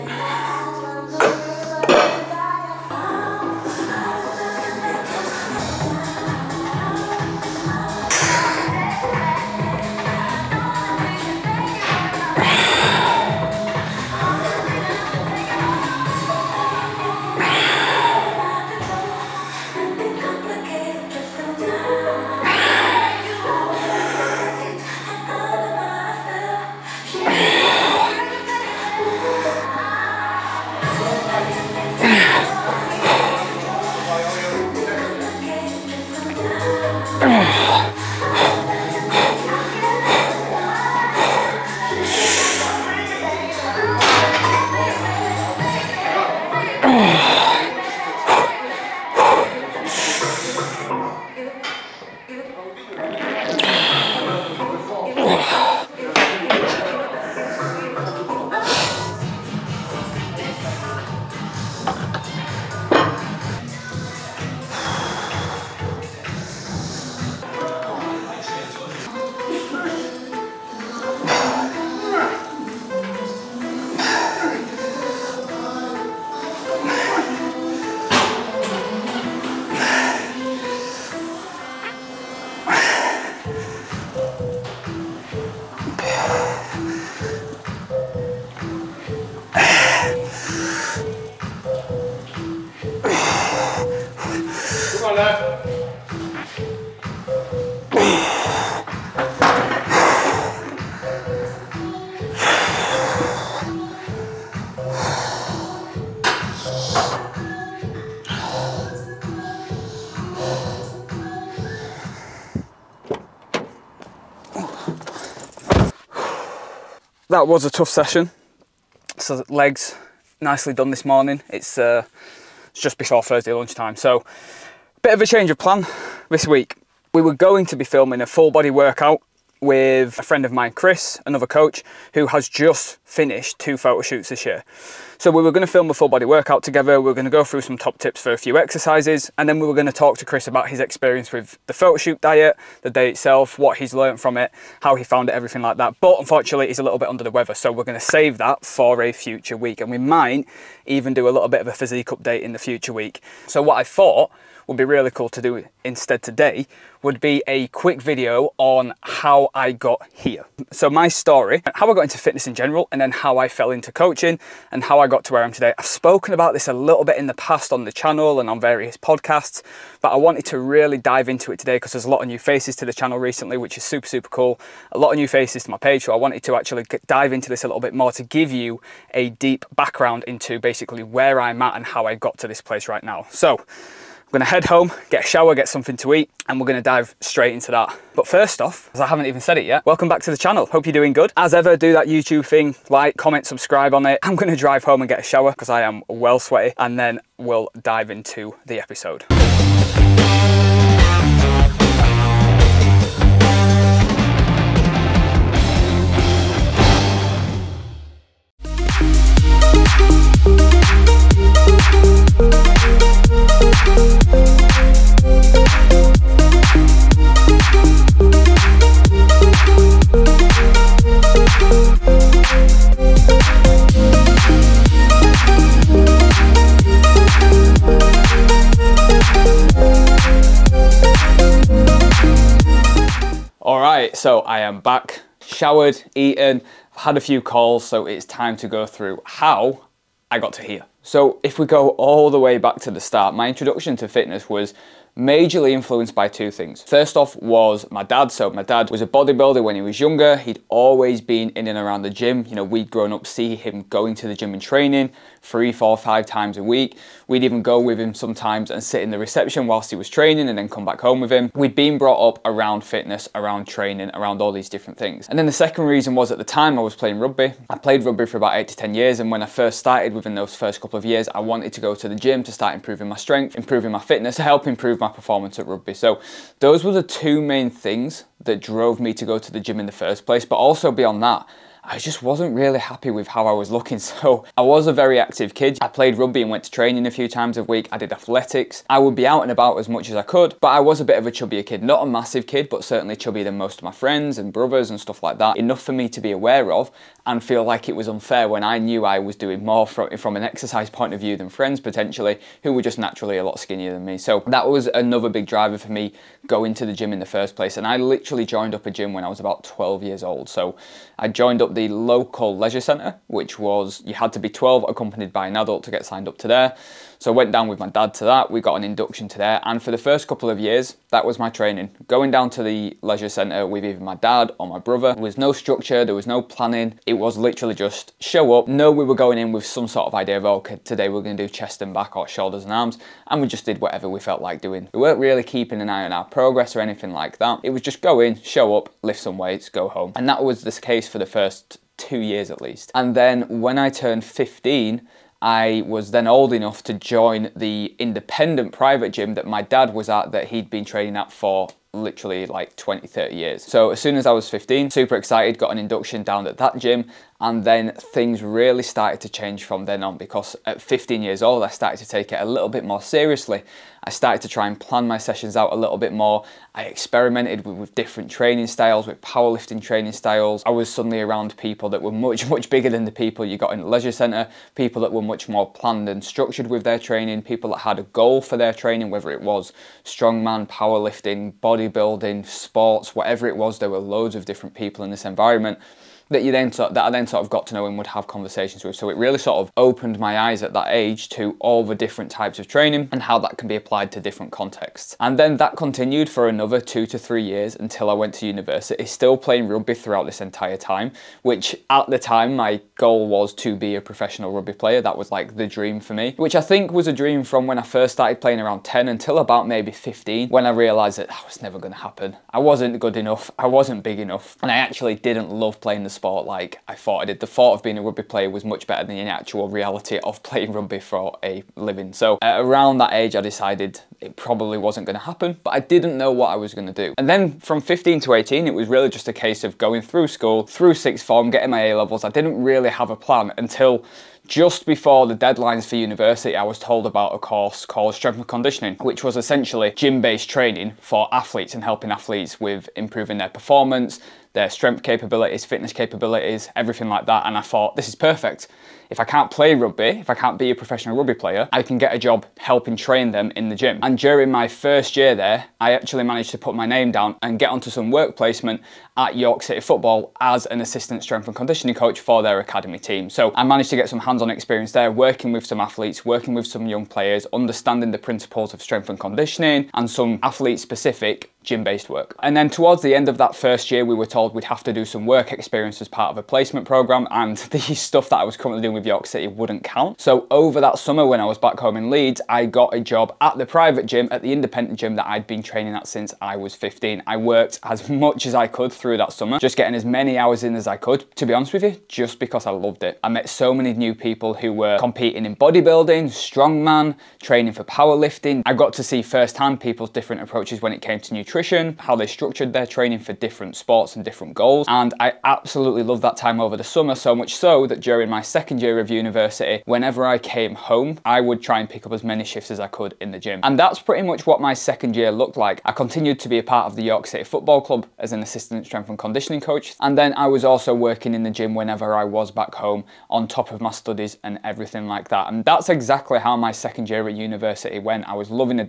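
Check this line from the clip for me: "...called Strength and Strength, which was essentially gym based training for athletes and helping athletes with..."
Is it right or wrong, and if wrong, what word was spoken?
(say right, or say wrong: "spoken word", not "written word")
wrong: "Conditioning", not "Strength".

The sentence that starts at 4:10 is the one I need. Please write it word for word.
He'd always been in and around the gym.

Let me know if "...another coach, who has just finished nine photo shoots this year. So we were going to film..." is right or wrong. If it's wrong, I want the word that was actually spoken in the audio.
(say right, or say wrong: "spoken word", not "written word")
wrong: "two", not "nine".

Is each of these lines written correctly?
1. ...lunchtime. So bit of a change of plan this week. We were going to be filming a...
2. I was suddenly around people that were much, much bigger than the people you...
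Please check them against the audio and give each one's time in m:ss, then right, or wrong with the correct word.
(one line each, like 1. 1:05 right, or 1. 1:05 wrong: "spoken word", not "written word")
1. 2:03 right
2. 6:10 right.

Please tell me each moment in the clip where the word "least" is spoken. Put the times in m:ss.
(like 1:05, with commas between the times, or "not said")
5:42.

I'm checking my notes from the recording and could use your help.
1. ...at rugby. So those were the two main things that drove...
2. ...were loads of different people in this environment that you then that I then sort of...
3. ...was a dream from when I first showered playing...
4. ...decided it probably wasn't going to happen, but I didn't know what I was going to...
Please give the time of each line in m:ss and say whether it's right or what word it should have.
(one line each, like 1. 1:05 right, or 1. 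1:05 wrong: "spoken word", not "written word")
1. 4:35 right
2. 6:23 right
3. 6:46 wrong: "started", not "showered"
4. 7:03 right.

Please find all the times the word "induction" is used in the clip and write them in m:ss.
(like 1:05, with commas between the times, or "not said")
5:18, 5:55.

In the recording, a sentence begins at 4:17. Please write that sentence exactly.
We'd even go with him sometimes and sit in the reception whilst he was training and then come back home with him.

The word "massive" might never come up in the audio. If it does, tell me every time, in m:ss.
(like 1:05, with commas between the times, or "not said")
4:52.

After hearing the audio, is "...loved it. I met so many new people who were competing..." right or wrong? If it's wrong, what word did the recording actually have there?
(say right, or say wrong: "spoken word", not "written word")
right.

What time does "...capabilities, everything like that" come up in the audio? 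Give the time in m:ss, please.
7:25.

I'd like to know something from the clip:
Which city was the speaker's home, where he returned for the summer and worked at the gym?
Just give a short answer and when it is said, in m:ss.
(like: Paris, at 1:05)
Leeds, at 8:02.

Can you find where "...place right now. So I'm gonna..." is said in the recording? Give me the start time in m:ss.
3:02.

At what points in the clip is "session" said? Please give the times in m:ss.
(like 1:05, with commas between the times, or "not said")
1:57, 6:05.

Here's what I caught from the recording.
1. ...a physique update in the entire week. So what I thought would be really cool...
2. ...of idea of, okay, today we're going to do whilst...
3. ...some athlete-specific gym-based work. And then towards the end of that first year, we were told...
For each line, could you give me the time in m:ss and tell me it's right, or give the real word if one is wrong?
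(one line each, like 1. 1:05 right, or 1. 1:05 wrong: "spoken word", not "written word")
1. 2:31 wrong: "future", not "entire"
2. 5:30 wrong: "chest", not "whilst"
3. 7:50 right.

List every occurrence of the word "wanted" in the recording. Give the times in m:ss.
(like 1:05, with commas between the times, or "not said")
2:50, 2:56, 4:31.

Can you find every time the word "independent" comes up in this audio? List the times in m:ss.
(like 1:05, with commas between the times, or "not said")
5:47, 8:04.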